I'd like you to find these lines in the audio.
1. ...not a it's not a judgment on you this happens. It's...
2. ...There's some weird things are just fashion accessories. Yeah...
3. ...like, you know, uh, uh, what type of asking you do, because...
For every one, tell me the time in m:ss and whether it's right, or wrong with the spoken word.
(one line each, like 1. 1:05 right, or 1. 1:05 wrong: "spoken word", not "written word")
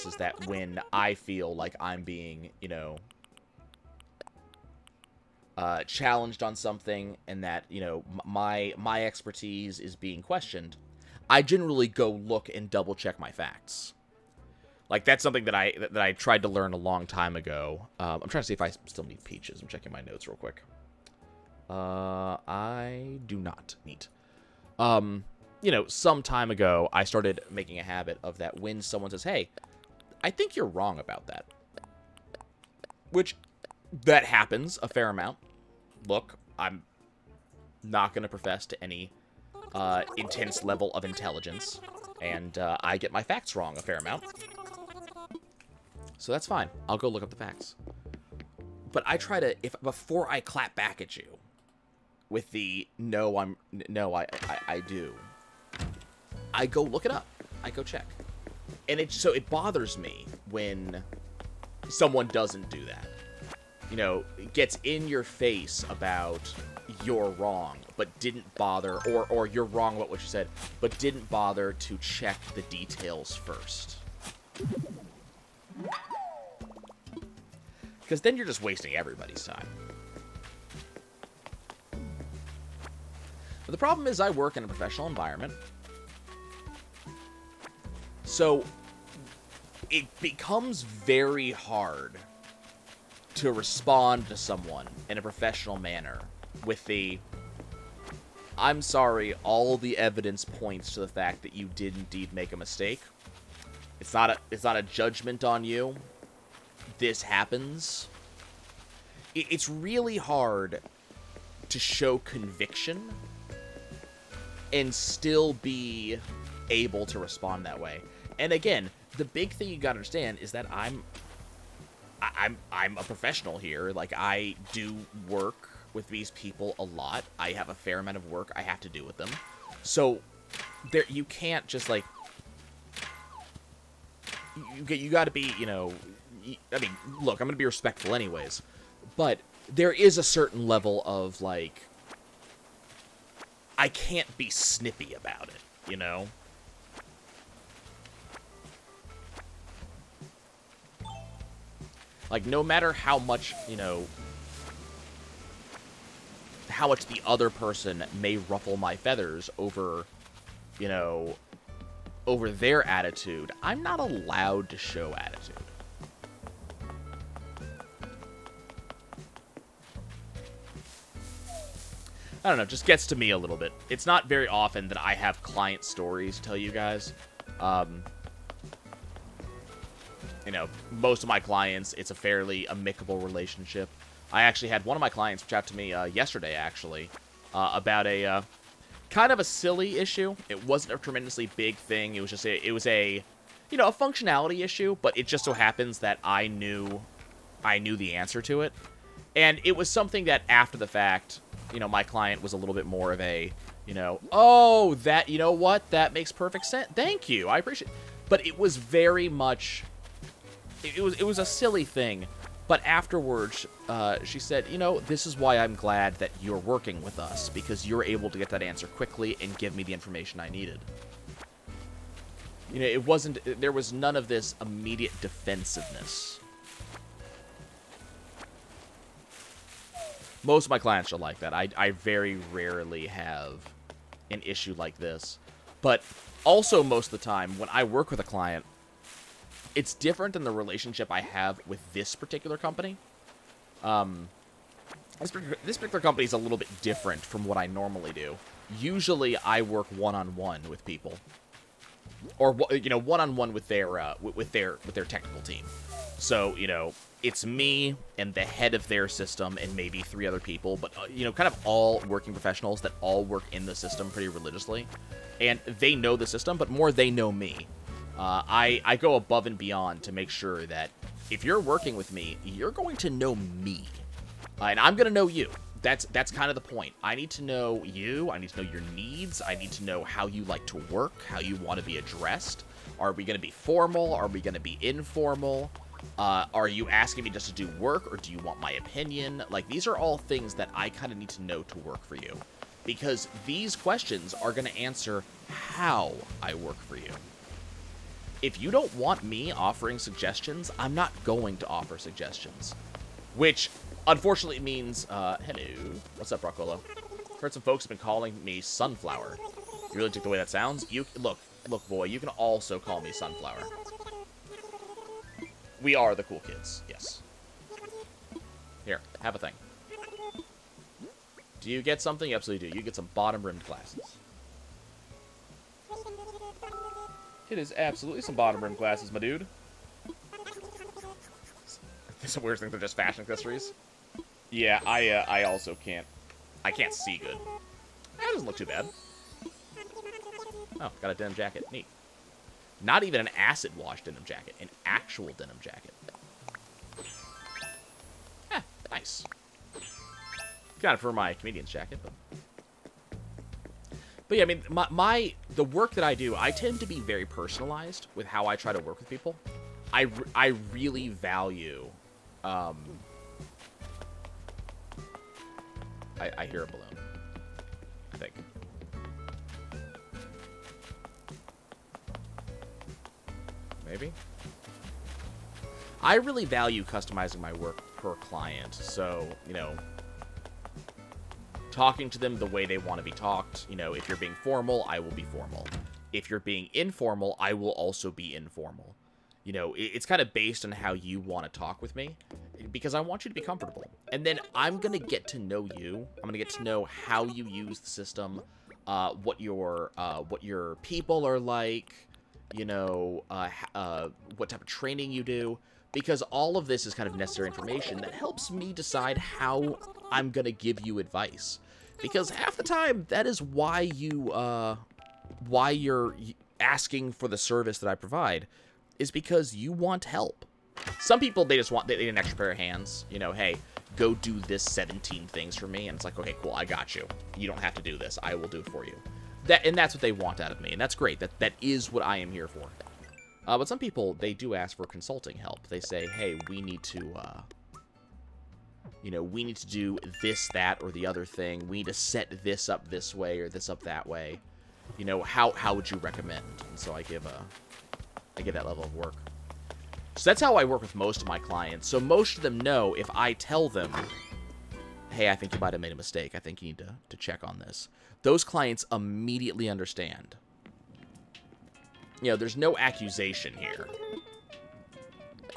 1. 1:44 right
2. 5:32 right
3. 6:41 wrong: "training", not "asking".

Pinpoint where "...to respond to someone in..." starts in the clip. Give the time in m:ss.
1:33.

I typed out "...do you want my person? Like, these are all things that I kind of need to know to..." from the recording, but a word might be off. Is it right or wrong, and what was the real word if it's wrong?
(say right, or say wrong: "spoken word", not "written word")
wrong: "opinion", not "person".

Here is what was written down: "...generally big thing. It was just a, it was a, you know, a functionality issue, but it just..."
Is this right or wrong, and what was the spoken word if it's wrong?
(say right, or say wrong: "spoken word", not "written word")
wrong: "tremendously", not "generally".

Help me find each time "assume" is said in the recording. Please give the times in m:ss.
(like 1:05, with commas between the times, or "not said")
not said.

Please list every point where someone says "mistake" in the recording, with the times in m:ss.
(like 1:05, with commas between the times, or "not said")
1:42, 7:35.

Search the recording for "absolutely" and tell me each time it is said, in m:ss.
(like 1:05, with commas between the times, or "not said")
5:22, 5:27.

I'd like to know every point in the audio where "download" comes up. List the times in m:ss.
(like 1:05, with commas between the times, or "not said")
not said.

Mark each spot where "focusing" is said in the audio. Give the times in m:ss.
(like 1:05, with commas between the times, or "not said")
not said.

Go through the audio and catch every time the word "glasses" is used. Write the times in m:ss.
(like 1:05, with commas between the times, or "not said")
5:23, 5:28.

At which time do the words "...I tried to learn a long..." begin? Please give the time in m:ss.
0:16.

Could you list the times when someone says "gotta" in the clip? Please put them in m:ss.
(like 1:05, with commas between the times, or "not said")
1:59.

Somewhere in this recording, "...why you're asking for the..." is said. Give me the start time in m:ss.
6:55.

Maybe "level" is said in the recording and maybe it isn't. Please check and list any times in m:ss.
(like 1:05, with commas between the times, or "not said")
0:40, 2:20, 7:28.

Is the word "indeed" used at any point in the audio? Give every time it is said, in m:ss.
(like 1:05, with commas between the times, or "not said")
1:41.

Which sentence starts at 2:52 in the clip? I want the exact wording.
I don't know, just gets to me a little bit.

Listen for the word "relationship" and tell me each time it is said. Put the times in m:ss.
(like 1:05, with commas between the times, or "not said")
3:03, 4:00.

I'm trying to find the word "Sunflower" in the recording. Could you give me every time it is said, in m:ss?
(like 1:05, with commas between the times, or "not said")
5:08, 5:13.